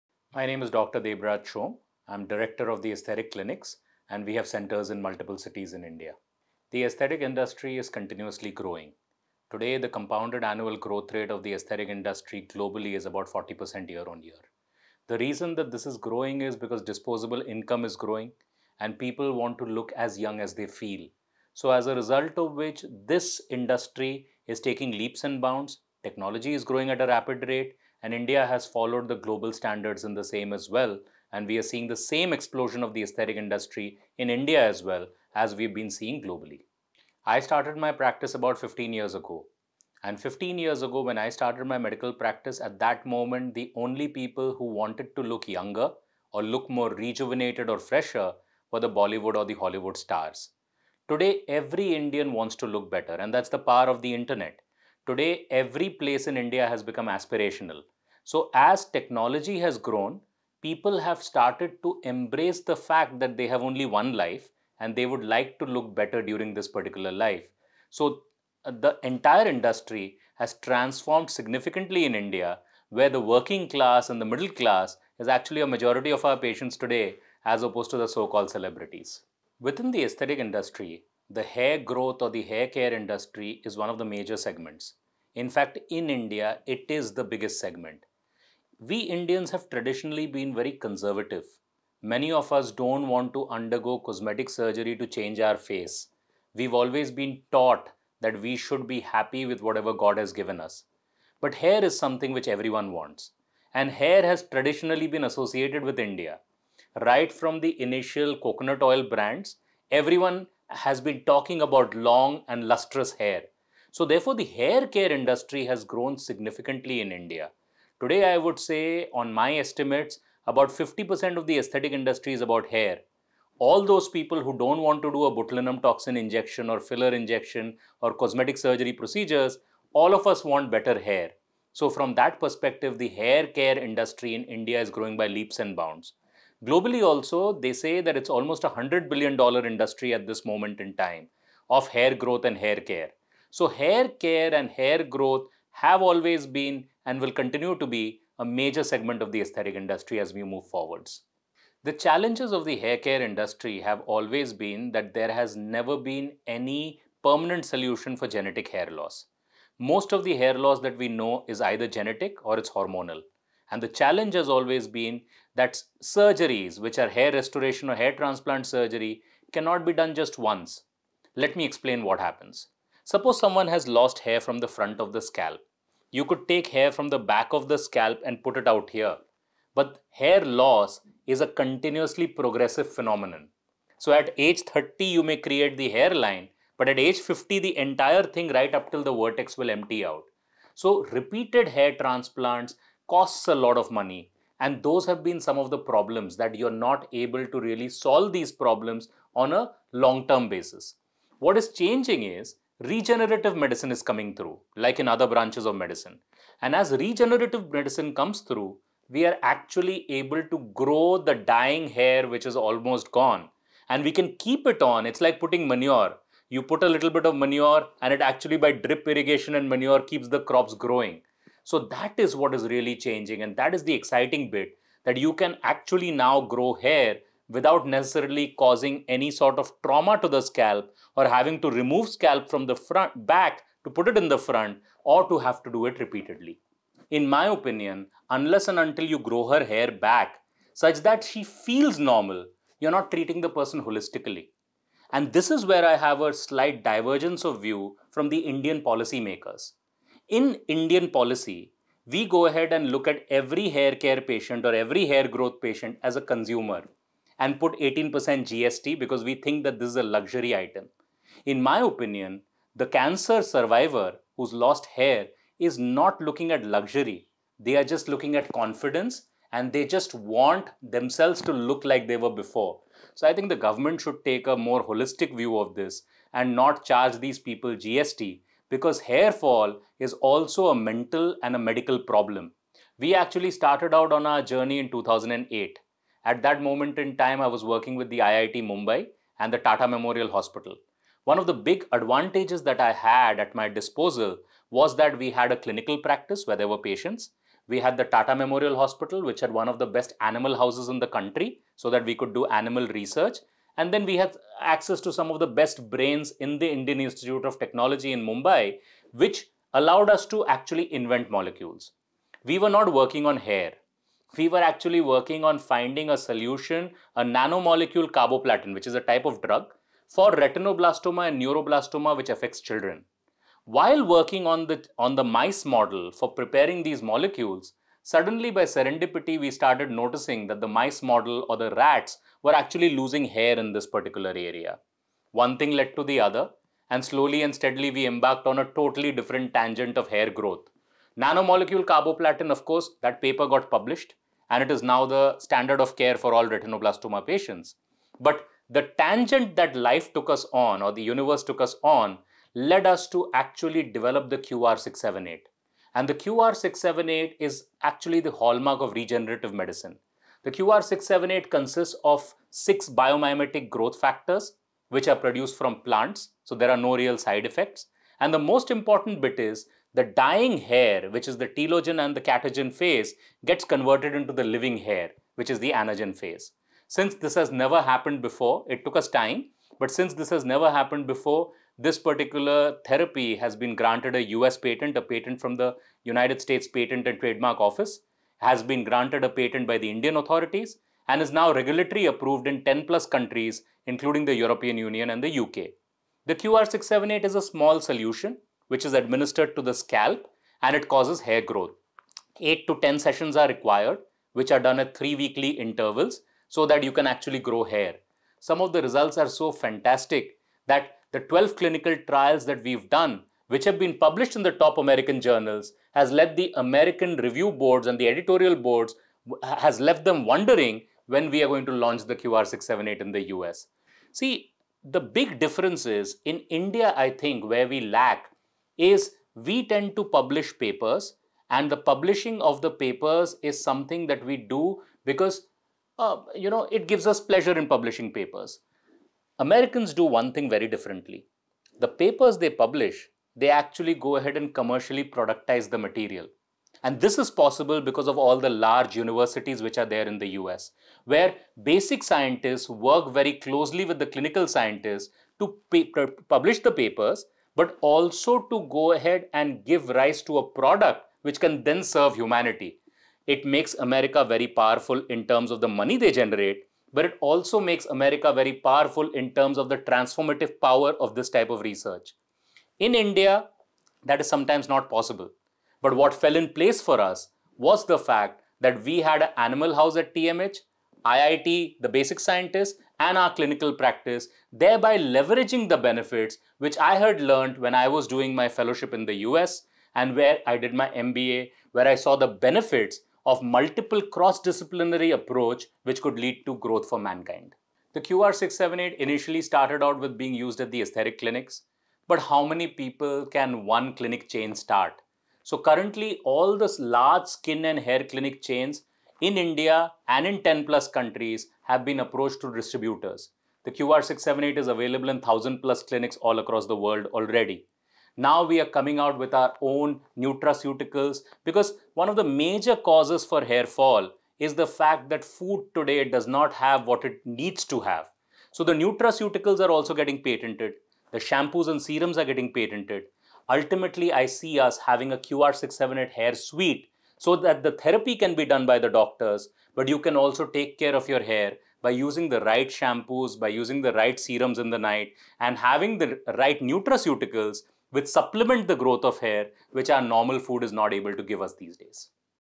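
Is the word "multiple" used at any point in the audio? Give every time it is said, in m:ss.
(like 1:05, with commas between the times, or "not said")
0:05, 8:13.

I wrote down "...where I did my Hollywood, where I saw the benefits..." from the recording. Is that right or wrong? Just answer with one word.
wrong.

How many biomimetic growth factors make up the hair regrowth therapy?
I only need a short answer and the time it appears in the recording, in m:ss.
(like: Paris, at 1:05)
6, at 6:02.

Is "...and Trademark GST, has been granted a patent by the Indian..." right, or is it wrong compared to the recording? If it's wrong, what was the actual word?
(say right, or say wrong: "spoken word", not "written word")
wrong: "Office", not "GST".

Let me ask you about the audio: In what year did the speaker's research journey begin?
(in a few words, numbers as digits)
2008.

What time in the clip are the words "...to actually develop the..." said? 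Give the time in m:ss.
5:53.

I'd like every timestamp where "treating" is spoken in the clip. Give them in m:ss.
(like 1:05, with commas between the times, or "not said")
4:03.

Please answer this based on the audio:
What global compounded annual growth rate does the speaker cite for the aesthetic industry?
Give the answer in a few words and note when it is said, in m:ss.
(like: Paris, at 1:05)
40%, at 0:13.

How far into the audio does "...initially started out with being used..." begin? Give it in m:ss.
8:18.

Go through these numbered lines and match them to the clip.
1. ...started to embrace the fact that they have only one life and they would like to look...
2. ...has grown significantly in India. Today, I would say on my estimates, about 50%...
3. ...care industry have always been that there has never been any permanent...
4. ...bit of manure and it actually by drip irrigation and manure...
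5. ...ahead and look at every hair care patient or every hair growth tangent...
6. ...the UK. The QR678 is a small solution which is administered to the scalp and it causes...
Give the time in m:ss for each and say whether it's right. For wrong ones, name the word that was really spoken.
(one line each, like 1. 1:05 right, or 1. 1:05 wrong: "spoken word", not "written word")
1. 1:01 right
2. 1:55 right
3. 2:32 right
4. 3:37 right
5. 4:12 wrong: "patient", not "tangent"
6. 6:35 right.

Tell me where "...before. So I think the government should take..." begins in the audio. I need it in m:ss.
4:32.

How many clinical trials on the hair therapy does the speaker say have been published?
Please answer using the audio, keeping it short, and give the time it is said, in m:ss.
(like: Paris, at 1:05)
12, at 6:51.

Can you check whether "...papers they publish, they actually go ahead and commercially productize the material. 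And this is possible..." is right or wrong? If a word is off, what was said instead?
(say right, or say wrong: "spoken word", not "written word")
right.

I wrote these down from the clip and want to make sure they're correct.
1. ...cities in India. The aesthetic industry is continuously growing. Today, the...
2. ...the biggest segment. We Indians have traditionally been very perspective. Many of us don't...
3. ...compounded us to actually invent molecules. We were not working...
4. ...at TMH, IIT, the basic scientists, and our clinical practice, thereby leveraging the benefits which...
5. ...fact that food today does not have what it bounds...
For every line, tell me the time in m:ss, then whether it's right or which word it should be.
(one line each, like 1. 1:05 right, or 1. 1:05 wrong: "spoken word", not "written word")
1. 0:05 right
2. 1:27 wrong: "conservative", not "perspective"
3. 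5:09 wrong: "allowed", not "compounded"
4. 7:59 right
5. 8:44 wrong: "needs", not "bounds".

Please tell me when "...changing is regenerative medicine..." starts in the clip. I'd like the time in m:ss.
3:21.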